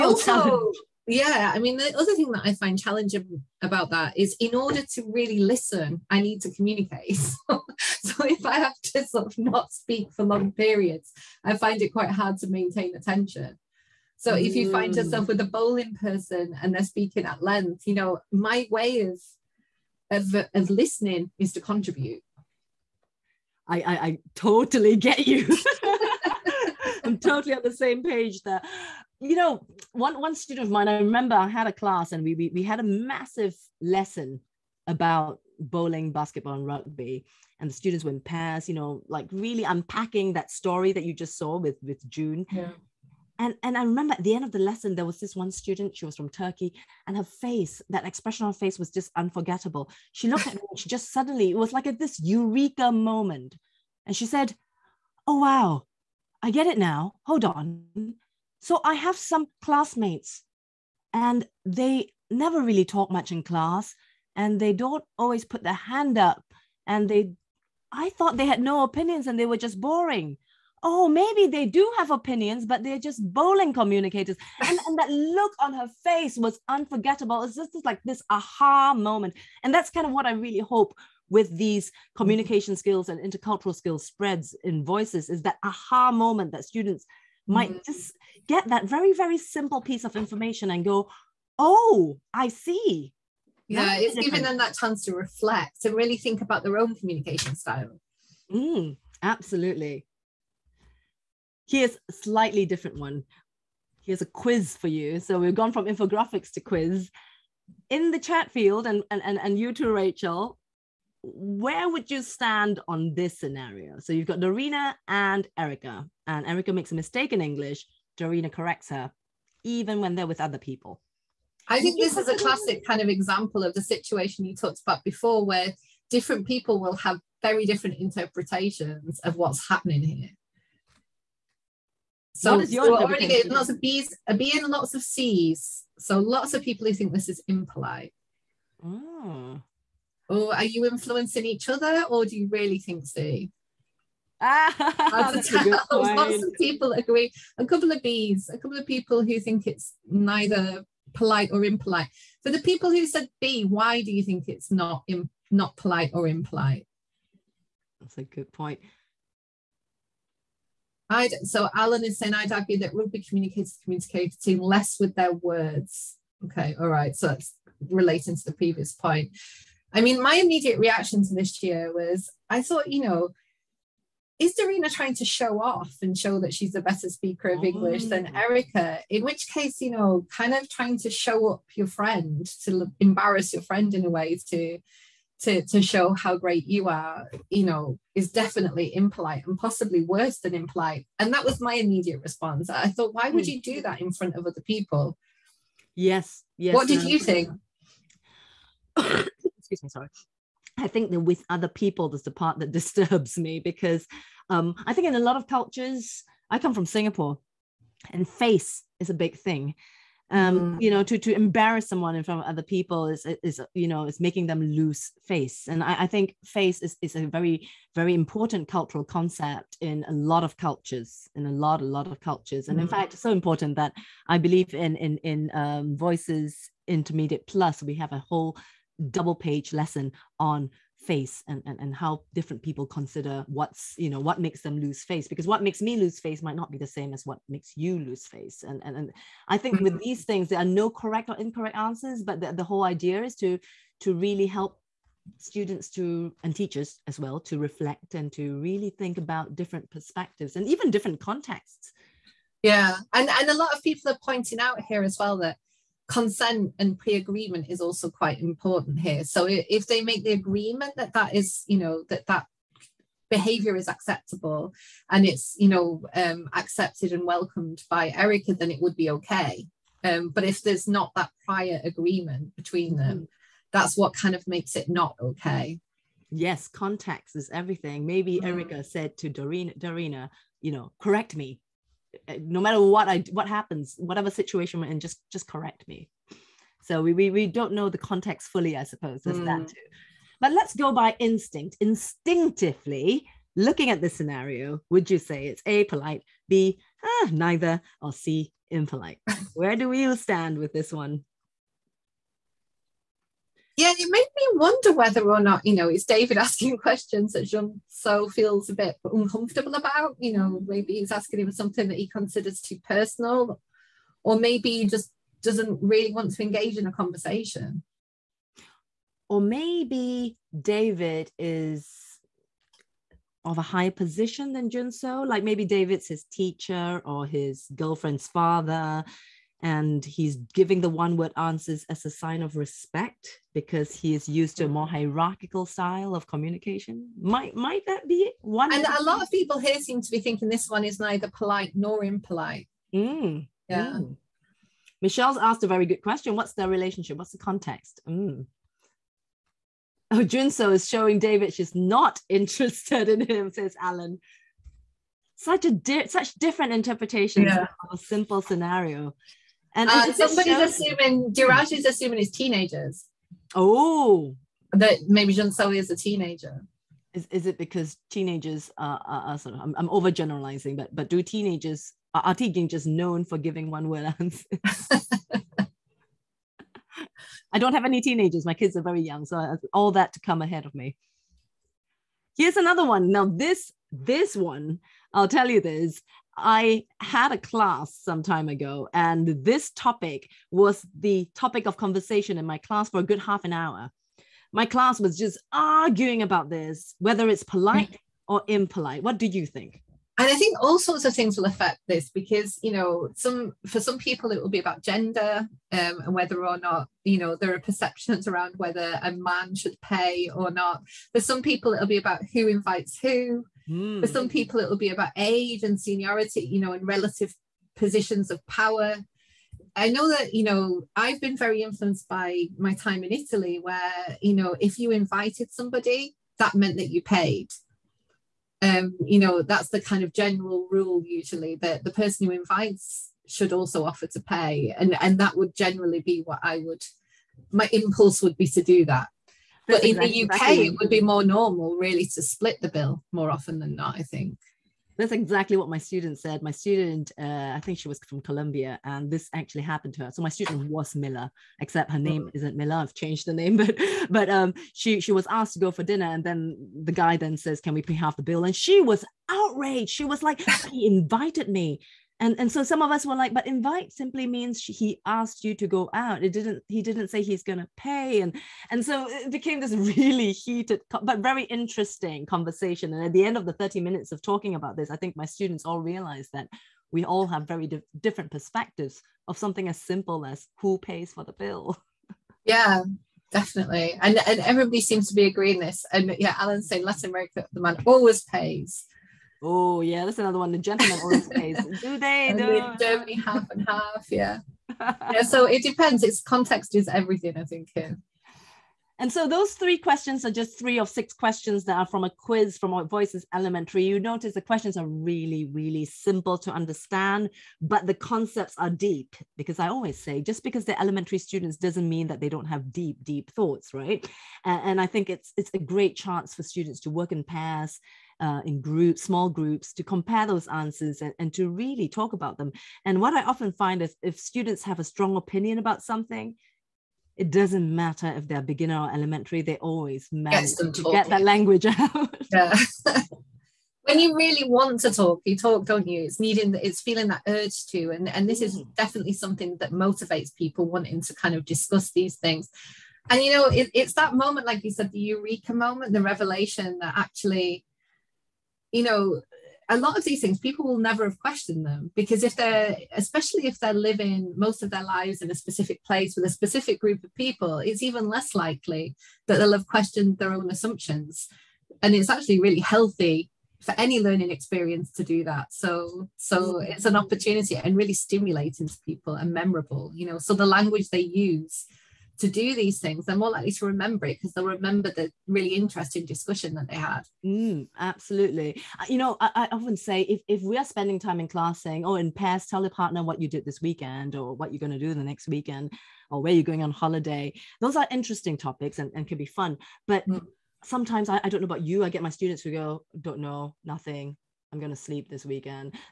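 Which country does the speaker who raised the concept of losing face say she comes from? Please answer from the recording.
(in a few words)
Singapore.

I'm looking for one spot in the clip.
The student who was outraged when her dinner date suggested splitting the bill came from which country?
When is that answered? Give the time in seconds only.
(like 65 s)
448 s.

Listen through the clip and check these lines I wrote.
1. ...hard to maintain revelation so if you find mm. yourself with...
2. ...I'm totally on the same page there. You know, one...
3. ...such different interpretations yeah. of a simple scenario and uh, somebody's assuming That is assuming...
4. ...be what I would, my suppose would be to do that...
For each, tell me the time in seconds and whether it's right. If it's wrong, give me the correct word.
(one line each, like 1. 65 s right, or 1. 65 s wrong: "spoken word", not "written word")
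1. 12 s wrong: "attention", not "revelation"
2. 27 s right
3. 356 s wrong: "Dhiraj", not "That"
4. 435 s wrong: "impulse", not "suppose".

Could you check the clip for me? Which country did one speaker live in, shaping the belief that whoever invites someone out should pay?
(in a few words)
Italy.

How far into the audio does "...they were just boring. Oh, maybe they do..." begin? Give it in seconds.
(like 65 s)
69 s.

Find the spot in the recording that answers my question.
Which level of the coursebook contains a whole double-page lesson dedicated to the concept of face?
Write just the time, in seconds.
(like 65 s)
226 s.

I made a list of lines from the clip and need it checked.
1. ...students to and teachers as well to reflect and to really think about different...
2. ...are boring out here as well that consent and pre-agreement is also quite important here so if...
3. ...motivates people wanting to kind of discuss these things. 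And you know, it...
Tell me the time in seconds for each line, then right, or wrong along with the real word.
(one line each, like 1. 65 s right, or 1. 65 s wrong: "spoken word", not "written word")
1. 245 s right
2. 254 s wrong: "pointing", not "boring"
3. 539 s right.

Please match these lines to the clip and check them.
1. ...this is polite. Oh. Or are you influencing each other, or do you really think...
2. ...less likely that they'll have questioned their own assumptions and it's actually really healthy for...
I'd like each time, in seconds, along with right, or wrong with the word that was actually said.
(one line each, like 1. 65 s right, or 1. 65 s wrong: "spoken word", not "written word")
1. 137 s wrong: "impolite", not "polite"
2. 558 s right.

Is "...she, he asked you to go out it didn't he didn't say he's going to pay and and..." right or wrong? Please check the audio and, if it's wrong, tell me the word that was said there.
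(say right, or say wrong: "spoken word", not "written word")
right.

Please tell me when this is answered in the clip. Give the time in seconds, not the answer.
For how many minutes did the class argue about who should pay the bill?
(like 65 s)
473 s.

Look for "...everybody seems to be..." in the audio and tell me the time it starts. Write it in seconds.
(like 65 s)
484 s.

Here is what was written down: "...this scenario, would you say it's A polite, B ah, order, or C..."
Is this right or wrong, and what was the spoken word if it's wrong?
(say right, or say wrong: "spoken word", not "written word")
wrong: "neither", not "order".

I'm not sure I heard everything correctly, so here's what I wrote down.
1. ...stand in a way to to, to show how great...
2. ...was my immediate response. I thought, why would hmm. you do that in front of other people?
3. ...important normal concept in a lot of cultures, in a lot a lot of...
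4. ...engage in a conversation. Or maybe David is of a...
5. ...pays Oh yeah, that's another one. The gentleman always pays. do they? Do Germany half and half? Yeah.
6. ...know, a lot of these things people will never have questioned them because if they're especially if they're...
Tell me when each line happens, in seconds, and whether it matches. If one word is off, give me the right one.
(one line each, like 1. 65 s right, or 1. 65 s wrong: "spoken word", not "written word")
1. 183 s wrong: "friend", not "stand"
2. 191 s right
3. 218 s wrong: "cultural", not "normal"
4. 316 s right
5. 488 s right
6. 548 s right.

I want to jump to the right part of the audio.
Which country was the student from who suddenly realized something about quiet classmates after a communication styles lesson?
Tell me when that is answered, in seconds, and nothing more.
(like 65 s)
46 s.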